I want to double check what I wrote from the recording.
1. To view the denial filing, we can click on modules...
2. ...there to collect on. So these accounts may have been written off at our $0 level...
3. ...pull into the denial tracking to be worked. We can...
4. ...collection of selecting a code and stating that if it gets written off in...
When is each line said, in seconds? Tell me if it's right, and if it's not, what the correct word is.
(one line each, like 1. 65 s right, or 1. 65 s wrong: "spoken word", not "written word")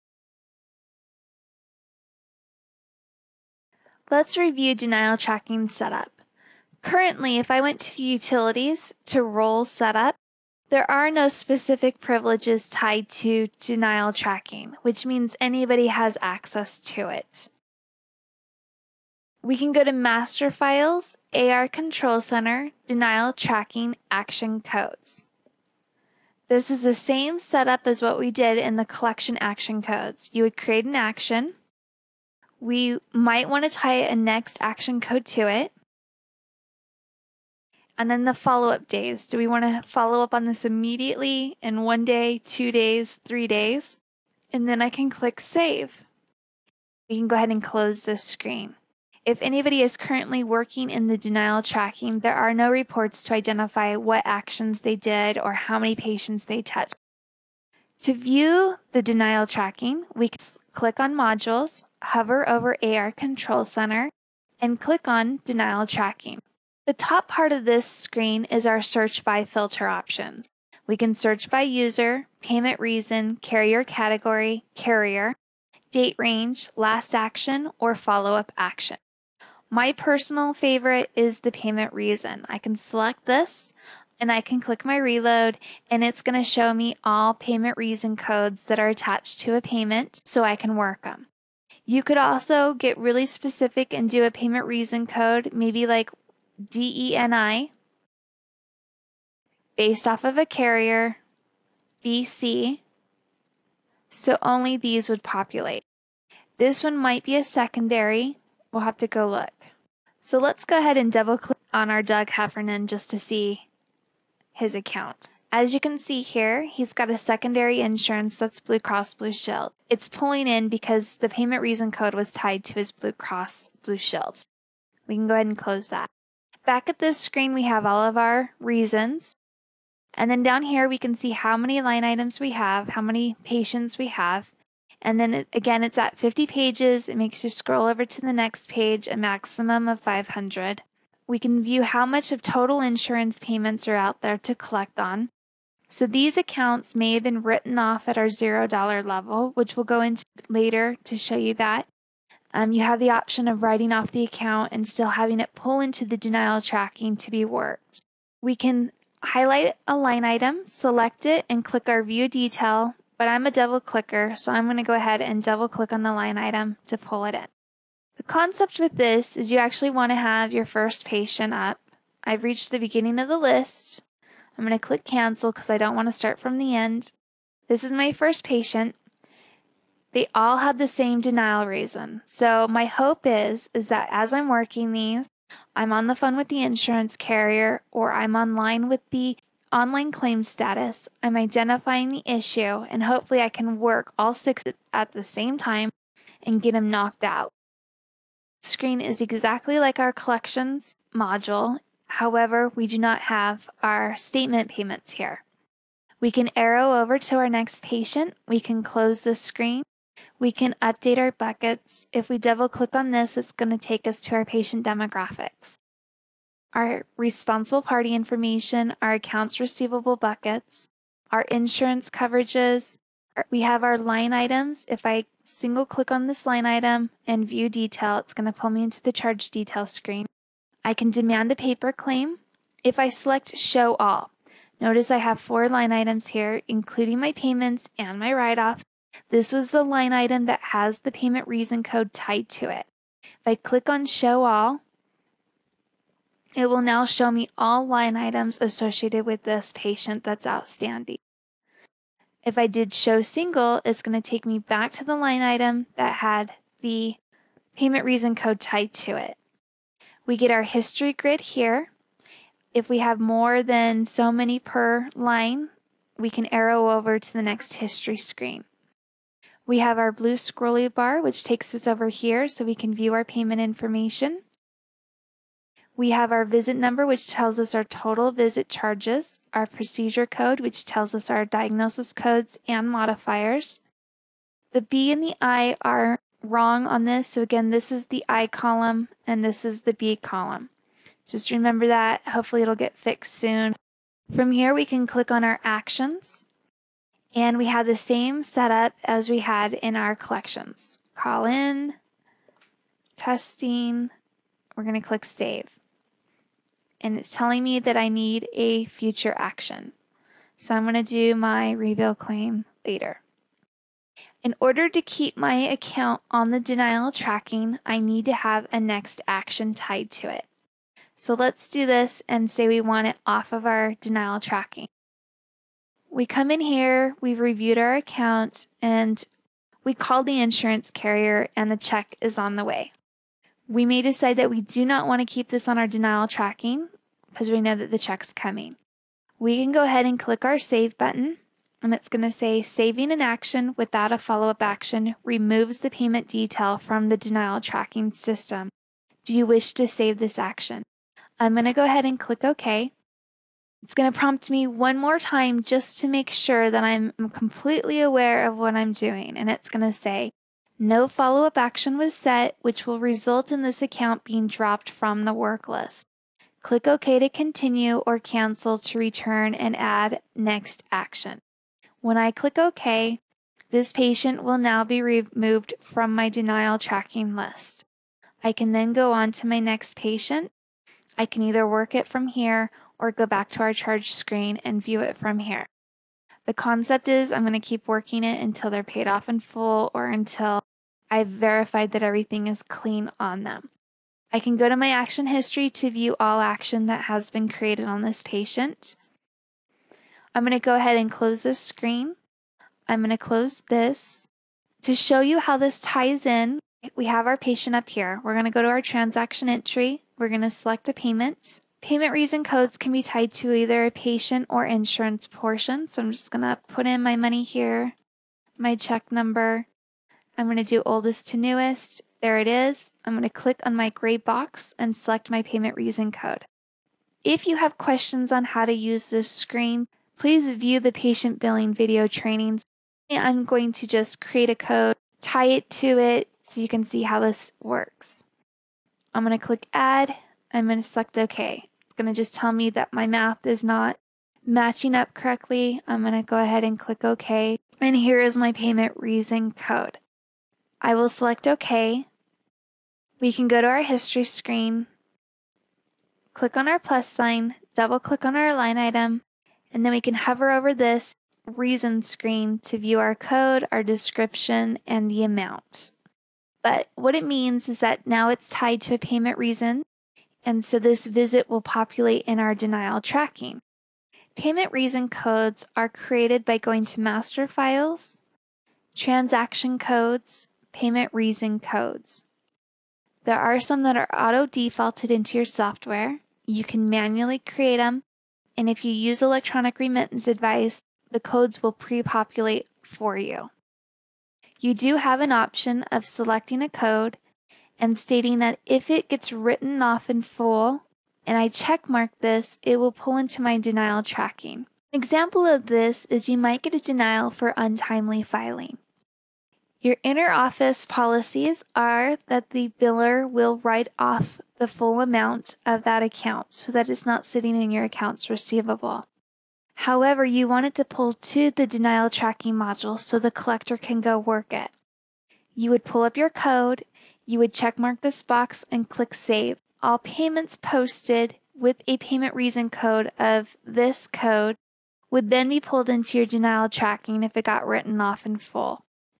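1. 58 s wrong: "tracking", not "filing"
2. 144 s right
3. 155 s right
4. 495 s wrong: "option", not "collection".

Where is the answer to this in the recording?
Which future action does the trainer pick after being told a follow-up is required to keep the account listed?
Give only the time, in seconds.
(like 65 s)
311 s.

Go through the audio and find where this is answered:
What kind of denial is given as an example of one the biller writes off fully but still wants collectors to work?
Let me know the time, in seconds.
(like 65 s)
507 s.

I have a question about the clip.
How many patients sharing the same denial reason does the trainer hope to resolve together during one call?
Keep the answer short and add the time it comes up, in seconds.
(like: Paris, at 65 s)
six, at 194 s.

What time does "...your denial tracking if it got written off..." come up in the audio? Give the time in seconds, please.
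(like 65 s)
536 s.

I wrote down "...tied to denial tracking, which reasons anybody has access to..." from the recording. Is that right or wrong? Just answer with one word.
wrong.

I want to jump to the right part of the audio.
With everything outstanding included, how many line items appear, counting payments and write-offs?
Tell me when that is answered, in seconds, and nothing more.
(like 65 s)
235 s.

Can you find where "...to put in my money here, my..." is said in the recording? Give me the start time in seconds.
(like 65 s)
416 s.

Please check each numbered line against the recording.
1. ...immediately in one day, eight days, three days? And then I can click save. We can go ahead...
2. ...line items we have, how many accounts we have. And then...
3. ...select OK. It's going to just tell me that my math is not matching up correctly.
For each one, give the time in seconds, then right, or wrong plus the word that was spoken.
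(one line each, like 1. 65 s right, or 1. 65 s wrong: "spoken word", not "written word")
1. 40 s wrong: "two", not "eight"
2. 131 s wrong: "patients", not "accounts"
3. 440 s right.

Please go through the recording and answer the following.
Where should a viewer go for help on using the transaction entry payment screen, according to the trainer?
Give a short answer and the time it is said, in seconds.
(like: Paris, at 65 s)
patient billing video trainings, at 430 s.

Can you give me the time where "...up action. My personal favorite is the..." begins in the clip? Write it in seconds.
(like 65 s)
78 s.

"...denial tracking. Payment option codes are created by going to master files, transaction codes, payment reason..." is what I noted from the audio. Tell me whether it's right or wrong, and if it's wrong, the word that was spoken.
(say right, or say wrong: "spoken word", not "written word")
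wrong: "reason", not "option".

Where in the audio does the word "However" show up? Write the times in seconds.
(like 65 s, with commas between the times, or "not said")
202 s, 519 s.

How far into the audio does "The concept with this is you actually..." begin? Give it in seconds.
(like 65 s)
168 s.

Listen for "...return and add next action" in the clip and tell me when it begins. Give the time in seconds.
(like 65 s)
368 s.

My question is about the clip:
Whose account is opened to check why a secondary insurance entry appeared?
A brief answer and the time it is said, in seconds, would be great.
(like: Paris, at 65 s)
Doug Heffernan, at 112 s.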